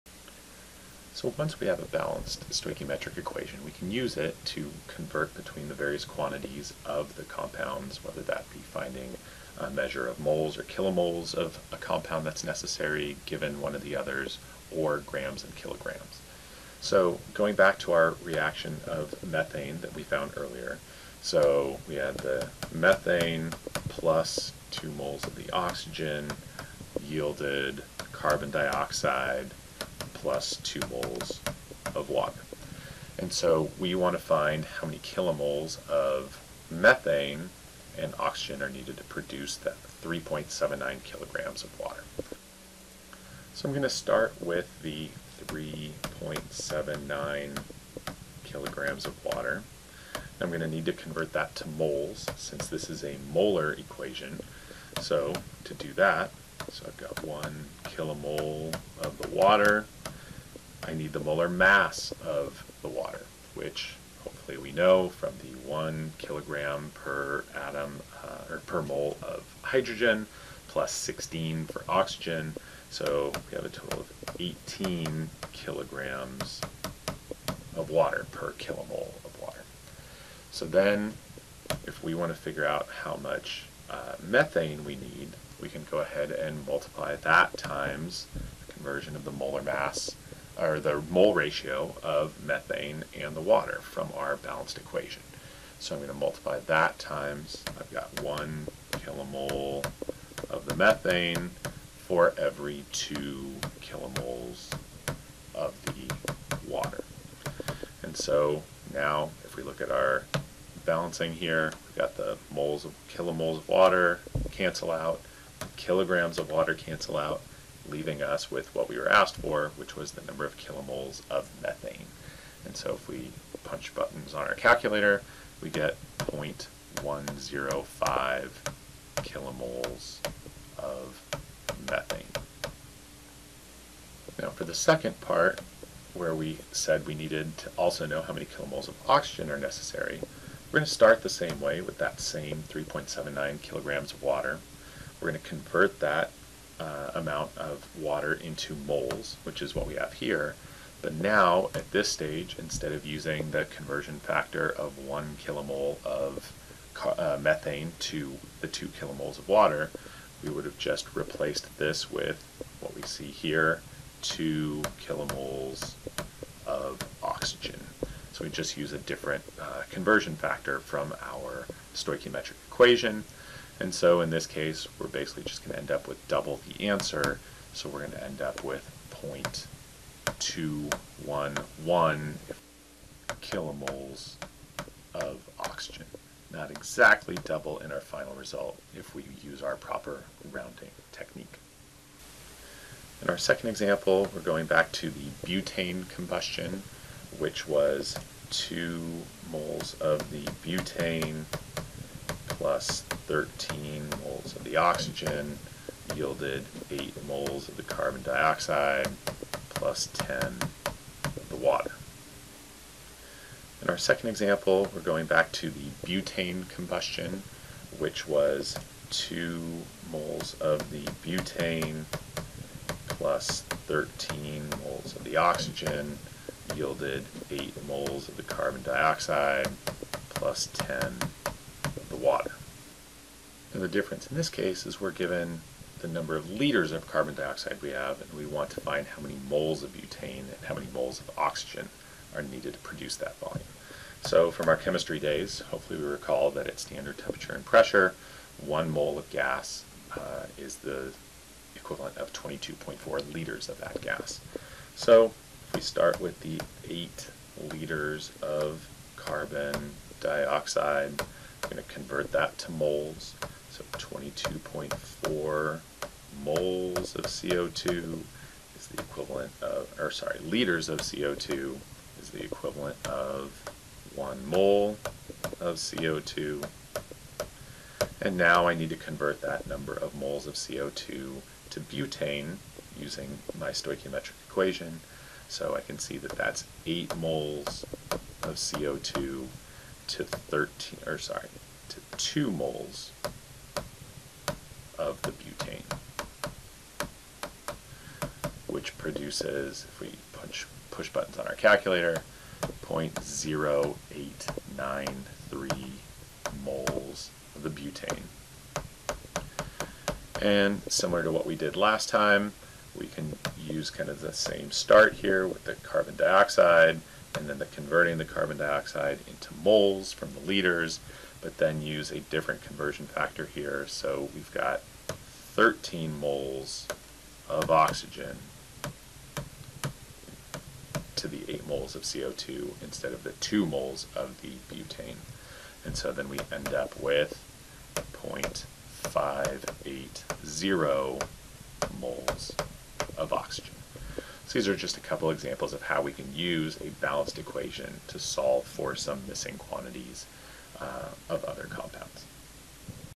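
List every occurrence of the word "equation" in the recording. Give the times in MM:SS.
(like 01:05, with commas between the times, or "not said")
00:03, 00:53, 01:34, 02:52, 04:44, 05:47.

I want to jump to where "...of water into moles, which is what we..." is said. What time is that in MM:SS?
02:27.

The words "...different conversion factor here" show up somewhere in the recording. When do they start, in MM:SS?
05:22.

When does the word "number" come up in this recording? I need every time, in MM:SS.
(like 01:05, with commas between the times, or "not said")
02:00, 03:56, 04:39.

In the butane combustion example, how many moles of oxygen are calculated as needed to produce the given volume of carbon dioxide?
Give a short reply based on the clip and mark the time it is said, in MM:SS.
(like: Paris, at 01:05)
0.580 moles, at 05:38.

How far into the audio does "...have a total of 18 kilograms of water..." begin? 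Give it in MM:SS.
01:13.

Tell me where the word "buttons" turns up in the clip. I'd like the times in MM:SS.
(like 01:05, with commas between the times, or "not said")
02:03, 05:01.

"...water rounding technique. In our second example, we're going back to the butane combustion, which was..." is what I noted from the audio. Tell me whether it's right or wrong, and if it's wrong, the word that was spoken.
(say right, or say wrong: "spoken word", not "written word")
wrong: "proper", not "water".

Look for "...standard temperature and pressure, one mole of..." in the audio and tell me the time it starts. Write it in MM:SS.
04:06.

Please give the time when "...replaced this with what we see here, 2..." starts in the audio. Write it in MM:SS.
02:41.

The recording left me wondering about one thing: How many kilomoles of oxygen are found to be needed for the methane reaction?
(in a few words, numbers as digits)
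0.211 kilomoles.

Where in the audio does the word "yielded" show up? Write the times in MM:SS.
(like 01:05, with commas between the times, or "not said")
00:27, 03:26, 03:46.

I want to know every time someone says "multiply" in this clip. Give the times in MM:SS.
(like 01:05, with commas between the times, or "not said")
01:26, 01:36.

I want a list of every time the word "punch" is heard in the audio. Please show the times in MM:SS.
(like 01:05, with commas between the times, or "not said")
02:03, 05:00.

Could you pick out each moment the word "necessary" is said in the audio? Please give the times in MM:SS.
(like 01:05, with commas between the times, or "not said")
00:12, 02:19.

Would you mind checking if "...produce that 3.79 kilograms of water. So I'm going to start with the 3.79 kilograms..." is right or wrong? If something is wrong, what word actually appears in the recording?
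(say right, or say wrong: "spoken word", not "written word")
right.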